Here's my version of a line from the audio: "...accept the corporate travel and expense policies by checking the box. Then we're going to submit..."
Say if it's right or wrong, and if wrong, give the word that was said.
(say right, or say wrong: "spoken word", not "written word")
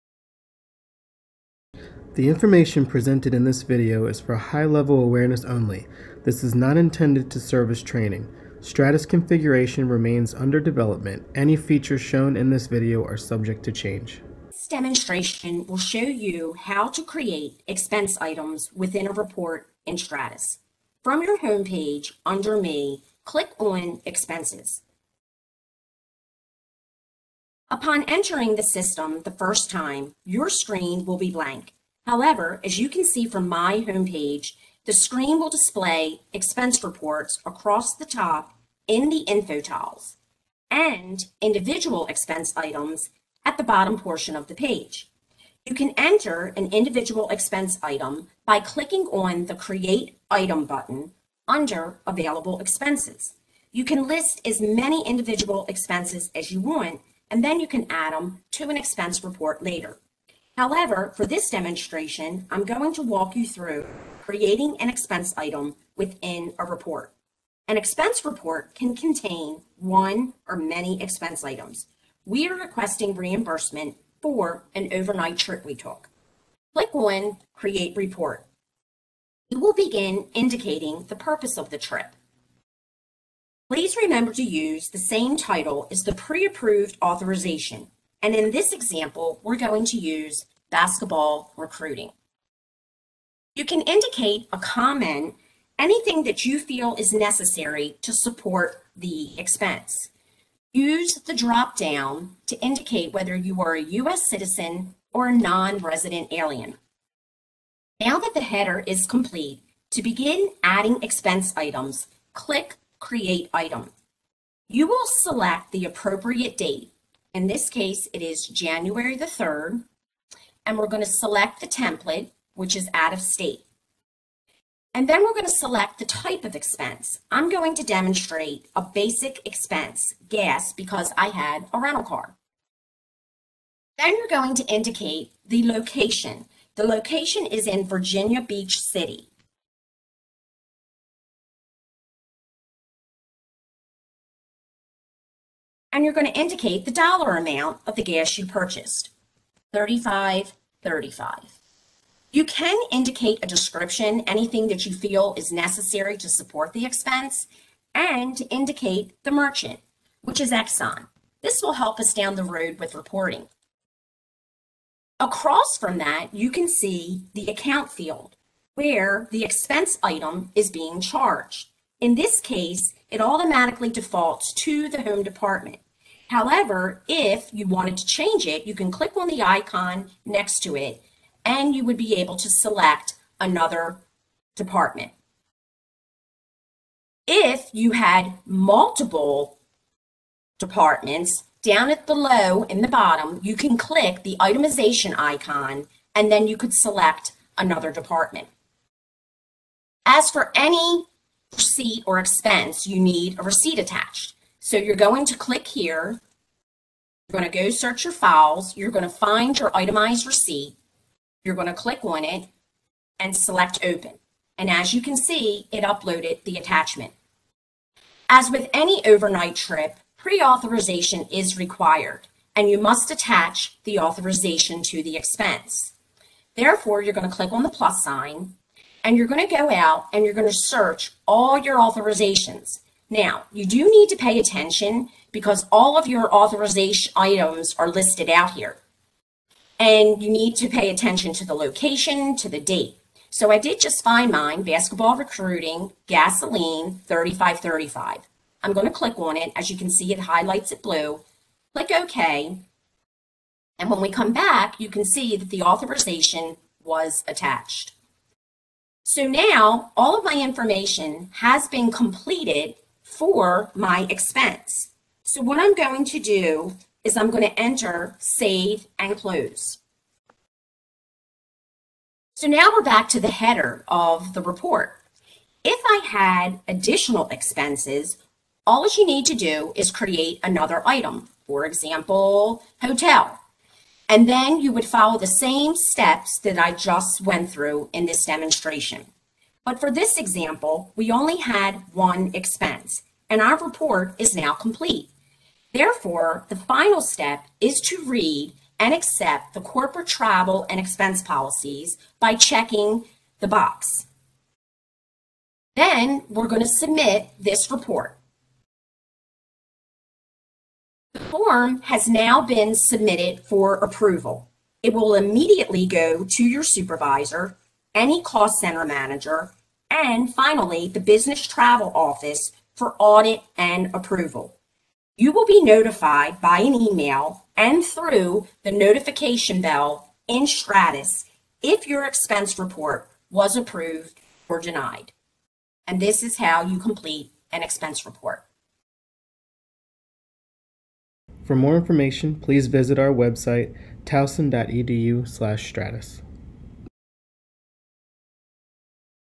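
right.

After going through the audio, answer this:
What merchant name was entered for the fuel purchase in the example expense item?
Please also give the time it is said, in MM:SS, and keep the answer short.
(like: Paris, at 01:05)
Exxon, at 02:40.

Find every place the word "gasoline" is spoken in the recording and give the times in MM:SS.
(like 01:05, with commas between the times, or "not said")
04:06.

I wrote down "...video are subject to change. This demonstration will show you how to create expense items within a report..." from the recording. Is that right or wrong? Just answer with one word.
right.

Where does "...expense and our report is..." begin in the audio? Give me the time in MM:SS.
04:52.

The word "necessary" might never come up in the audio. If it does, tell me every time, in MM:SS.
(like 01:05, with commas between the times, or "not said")
01:37, 02:35.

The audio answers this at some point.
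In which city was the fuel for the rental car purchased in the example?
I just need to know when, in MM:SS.
02:17.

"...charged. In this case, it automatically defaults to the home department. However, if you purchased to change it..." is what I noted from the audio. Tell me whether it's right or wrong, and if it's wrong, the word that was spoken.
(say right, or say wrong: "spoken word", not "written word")
wrong: "wanted", not "purchased".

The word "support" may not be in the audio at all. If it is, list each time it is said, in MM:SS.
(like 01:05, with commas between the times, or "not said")
01:38, 02:36.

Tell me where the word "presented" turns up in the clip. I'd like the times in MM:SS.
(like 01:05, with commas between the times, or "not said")
00:02.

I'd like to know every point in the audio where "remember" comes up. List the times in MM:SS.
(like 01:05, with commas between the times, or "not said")
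01:23.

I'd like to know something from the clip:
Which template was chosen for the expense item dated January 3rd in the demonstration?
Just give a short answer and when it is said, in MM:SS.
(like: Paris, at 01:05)
out of state, at 02:02.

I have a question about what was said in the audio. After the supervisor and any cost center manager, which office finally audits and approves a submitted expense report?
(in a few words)
business travel office.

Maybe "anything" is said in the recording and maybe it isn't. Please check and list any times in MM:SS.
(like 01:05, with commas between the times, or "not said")
01:35, 02:34.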